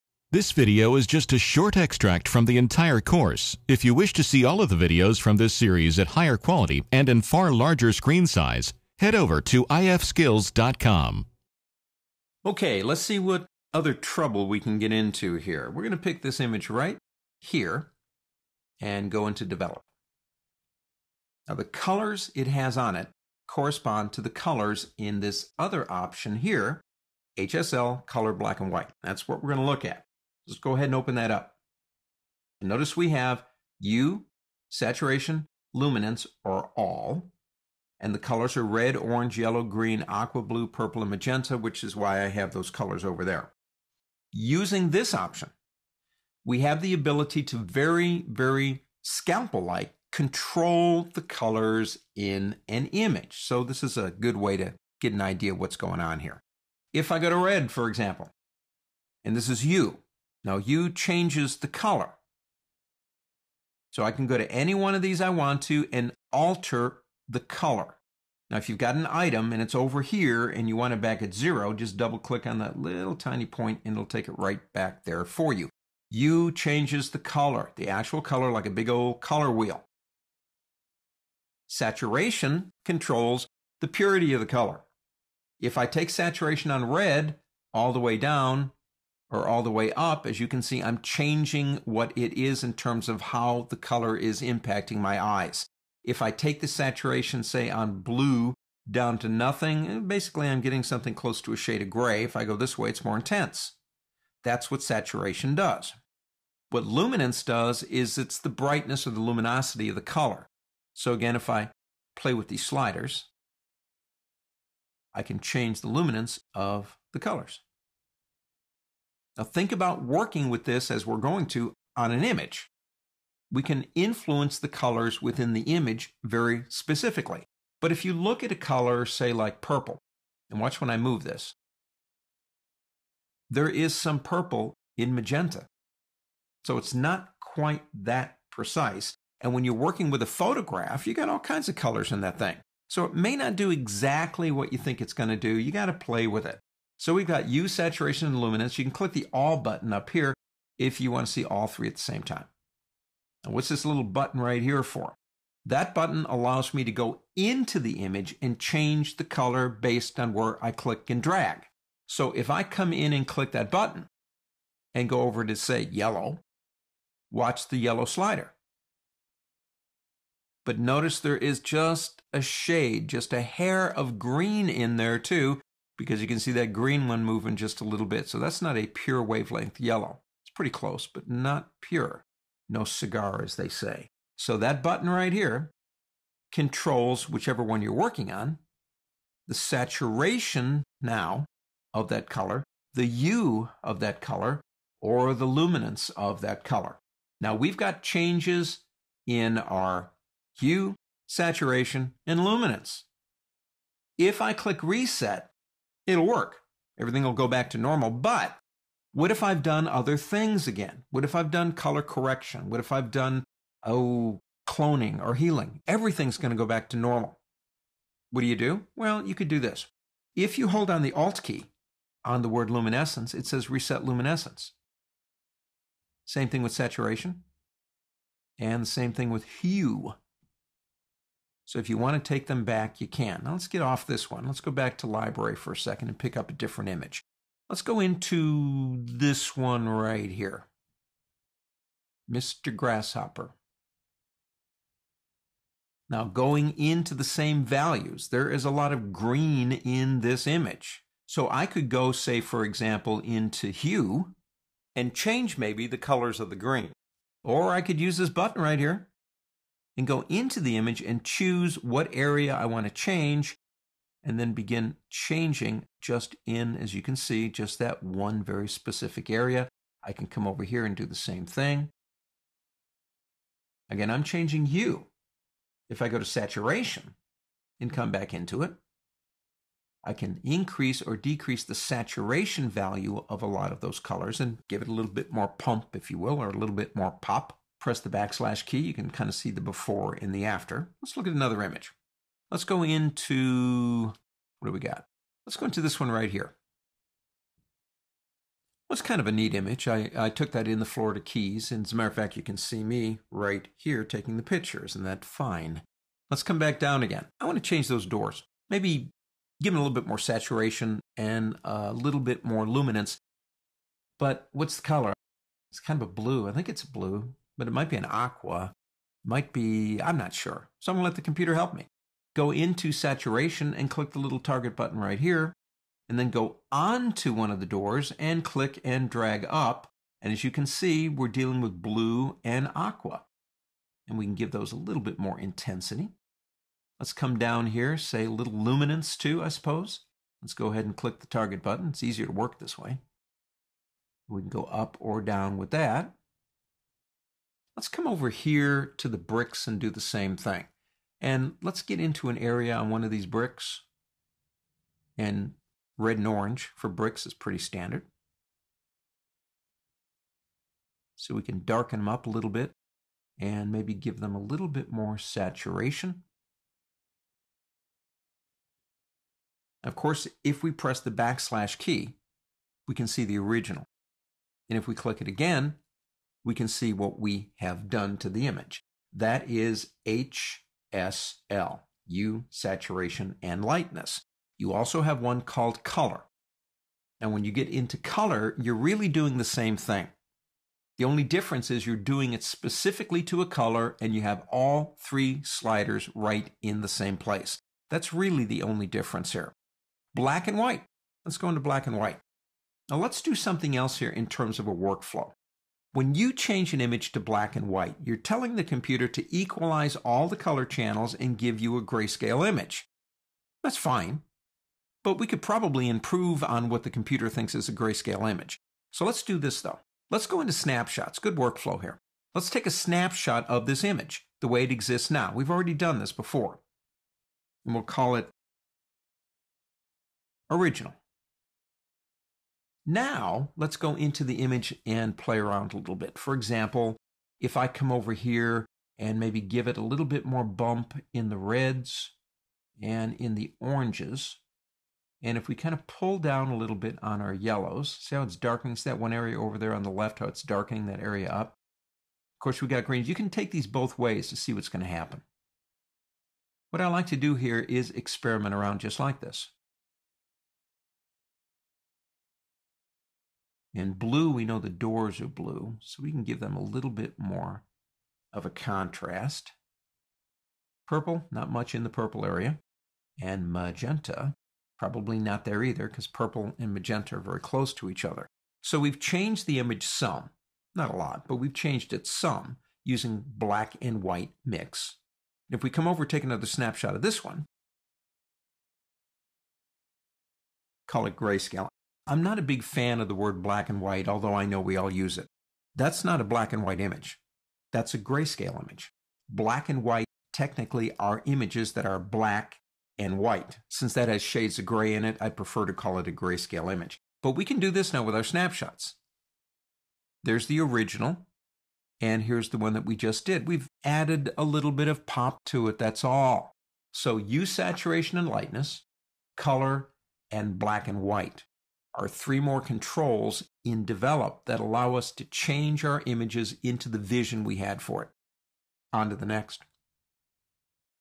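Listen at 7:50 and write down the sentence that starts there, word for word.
Purple, not much in the purple area.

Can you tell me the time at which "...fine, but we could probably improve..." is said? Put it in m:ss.
6:53.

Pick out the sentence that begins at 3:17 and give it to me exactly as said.
Now we've got changes in our hue, saturation, and luminance.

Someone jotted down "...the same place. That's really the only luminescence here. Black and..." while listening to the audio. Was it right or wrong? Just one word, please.
wrong.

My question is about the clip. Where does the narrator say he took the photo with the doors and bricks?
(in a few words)
Florida Keys.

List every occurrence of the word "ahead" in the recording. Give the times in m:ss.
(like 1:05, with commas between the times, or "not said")
0:30, 5:40.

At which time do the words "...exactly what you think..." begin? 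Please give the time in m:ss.
2:23.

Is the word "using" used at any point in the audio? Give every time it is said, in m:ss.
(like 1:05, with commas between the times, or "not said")
0:44, 8:02.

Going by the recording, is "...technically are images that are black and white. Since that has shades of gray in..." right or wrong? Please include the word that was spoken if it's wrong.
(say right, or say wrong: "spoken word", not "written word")
right.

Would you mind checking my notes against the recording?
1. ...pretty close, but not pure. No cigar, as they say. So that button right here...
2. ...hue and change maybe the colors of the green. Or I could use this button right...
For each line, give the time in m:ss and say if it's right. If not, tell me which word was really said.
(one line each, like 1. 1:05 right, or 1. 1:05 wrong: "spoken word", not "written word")
1. 3:00 right
2. 4:13 right.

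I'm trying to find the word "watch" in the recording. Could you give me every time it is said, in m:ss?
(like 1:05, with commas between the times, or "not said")
2:10, 2:47.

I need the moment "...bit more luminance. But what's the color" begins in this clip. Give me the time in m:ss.
5:12.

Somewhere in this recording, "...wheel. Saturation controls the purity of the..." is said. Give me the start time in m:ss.
1:19.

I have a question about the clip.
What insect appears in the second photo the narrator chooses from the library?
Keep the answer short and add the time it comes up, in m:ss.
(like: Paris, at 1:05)
grasshopper, at 4:02.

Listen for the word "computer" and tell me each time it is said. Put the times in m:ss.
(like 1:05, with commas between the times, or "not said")
5:21, 6:48, 6:56.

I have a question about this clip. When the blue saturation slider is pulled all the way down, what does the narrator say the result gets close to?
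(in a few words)
a shade of gray.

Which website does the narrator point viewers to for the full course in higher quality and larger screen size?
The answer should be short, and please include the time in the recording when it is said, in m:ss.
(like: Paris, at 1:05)
ifskills.com, at 0:09.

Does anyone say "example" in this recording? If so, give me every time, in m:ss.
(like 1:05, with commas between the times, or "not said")
0:57, 4:12, 7:16.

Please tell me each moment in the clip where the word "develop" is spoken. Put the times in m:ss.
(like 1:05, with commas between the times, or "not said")
0:19, 8:43.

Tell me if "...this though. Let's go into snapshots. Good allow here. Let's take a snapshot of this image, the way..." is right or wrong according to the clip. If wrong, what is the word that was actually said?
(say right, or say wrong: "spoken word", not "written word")
wrong: "workflow", not "allow".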